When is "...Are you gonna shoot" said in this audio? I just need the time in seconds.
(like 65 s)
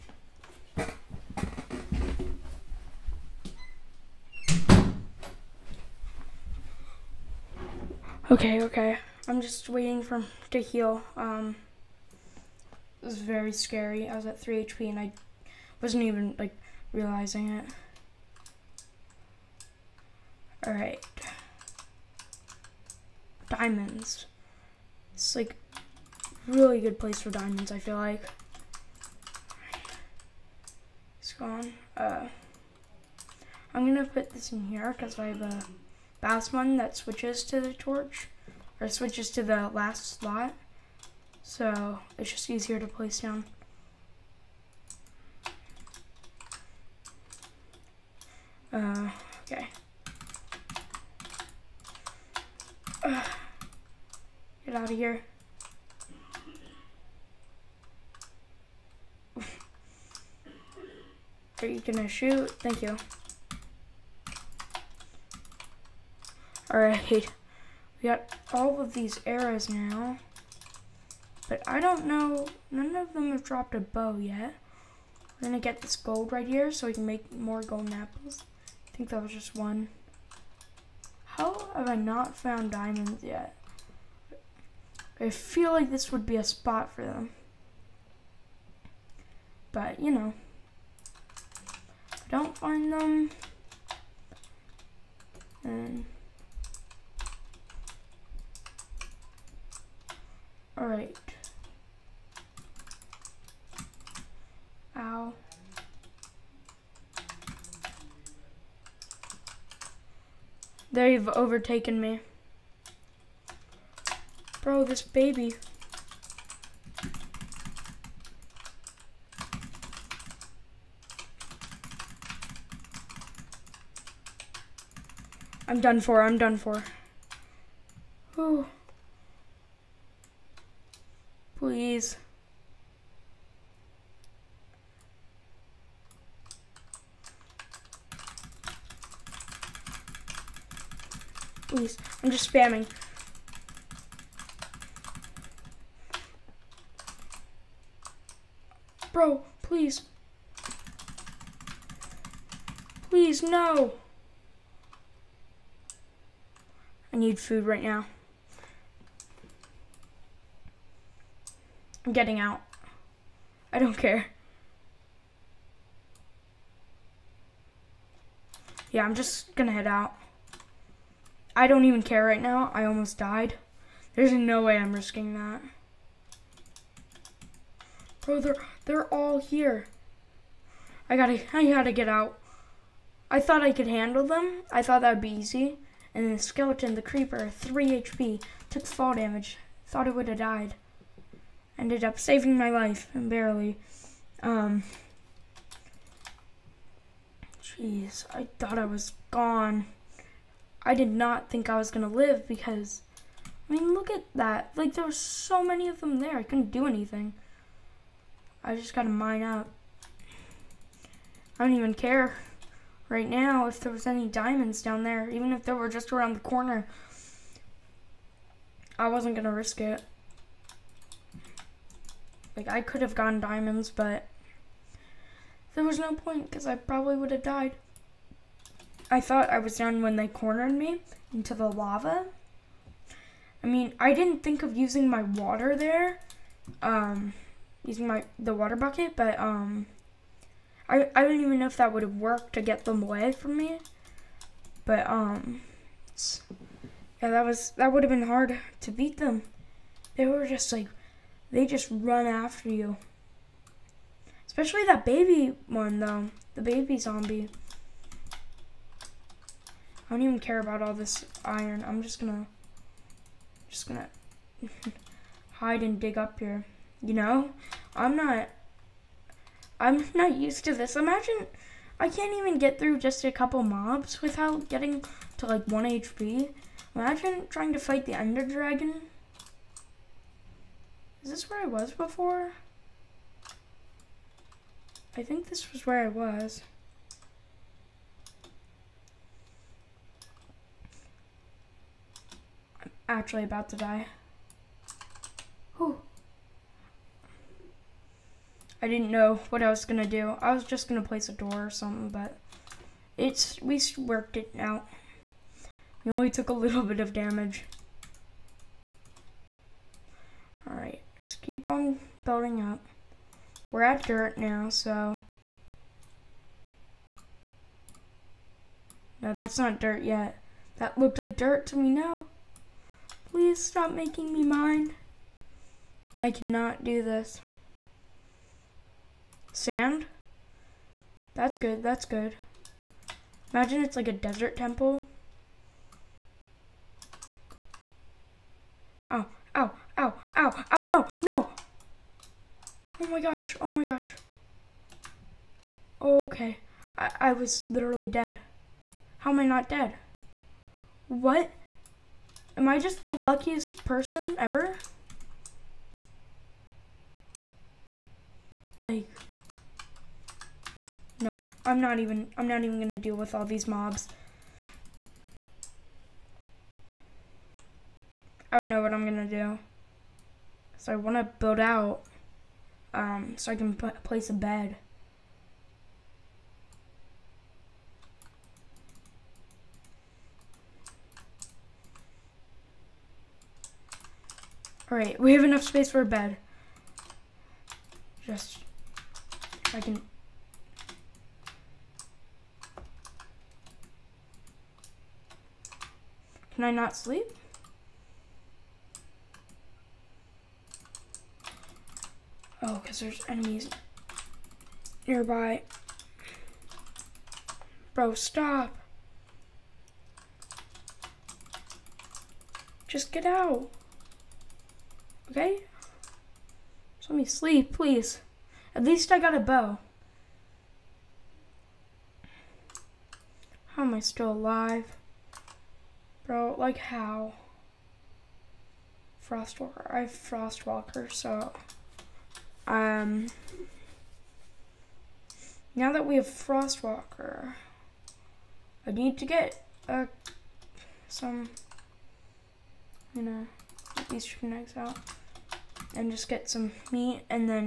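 59 s.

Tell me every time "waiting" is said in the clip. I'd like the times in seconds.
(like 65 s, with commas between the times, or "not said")
9 s.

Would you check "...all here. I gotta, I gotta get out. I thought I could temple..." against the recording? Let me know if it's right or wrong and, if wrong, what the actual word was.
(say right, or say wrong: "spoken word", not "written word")
wrong: "handle", not "temple".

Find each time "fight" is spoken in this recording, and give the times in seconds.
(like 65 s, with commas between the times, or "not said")
277 s.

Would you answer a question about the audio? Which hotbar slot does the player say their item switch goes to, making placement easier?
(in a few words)
The last slot.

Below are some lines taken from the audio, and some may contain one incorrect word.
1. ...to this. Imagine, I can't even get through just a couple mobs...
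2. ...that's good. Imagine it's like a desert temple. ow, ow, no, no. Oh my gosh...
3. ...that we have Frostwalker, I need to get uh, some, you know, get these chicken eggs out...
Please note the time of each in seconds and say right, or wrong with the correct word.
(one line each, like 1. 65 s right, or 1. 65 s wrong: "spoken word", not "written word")
1. 270 s right
2. 331 s right
3. 435 s right.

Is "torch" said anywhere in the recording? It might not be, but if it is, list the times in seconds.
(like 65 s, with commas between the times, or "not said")
37 s.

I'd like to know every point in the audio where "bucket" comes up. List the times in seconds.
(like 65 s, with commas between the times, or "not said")
238 s.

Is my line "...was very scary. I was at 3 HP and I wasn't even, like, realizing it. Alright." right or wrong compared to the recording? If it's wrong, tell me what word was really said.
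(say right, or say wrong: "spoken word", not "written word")
right.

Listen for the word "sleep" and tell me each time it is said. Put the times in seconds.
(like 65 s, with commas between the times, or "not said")
396 s, 417 s.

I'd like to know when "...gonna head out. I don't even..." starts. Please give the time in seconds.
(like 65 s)
169 s.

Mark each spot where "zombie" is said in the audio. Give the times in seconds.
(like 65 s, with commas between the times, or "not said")
256 s.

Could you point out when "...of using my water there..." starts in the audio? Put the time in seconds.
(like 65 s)
234 s.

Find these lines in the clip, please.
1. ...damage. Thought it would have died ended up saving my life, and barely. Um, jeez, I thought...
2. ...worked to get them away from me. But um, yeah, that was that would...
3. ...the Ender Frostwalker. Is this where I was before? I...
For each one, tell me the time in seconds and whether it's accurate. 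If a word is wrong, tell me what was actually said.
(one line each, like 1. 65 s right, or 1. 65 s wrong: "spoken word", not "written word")
1. 189 s right
2. 242 s right
3. 278 s wrong: "Dragon", not "Frostwalker".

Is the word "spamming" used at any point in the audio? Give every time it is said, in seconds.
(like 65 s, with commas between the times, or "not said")
142 s.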